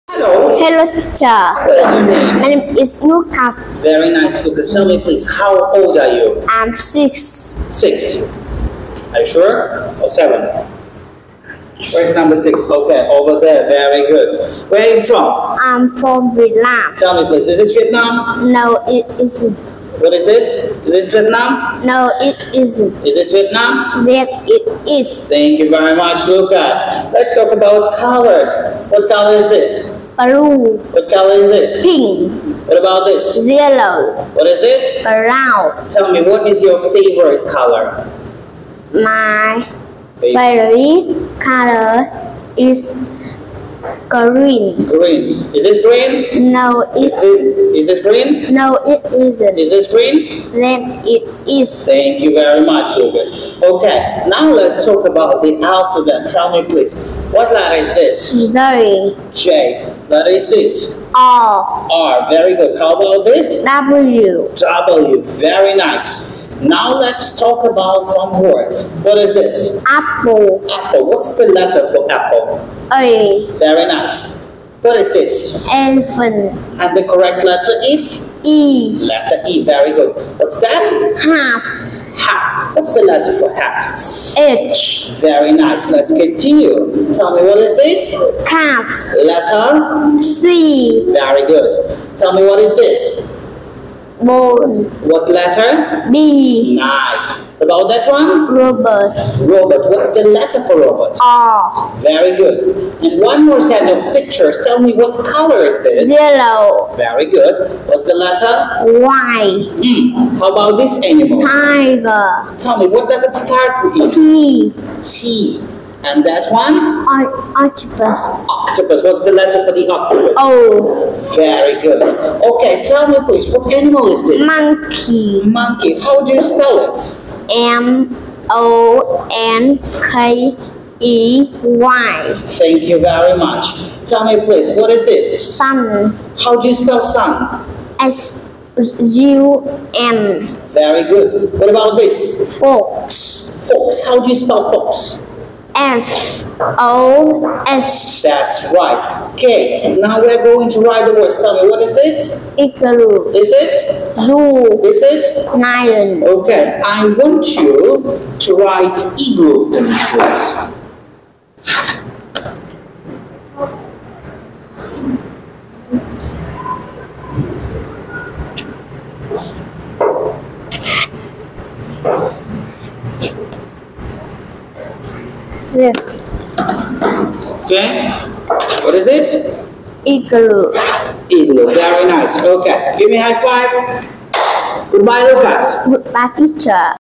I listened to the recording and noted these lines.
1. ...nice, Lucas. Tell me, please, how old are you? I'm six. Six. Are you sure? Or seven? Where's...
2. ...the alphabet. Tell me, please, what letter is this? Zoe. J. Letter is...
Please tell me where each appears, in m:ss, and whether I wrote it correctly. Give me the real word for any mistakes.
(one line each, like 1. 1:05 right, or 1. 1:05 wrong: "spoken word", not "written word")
1. 0:04 right
2. 0:55 right.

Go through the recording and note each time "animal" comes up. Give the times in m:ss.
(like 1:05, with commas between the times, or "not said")
1:51, 2:03.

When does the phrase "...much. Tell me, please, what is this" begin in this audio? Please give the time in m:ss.
2:13.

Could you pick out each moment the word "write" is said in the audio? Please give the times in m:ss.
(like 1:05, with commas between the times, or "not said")
2:30, 2:38.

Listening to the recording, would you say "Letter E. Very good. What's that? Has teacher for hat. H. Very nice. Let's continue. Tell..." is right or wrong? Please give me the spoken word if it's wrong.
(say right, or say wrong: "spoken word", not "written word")
wrong: "letter", not "teacher".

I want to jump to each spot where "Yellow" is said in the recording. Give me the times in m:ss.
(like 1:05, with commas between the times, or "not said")
0:33, 1:46.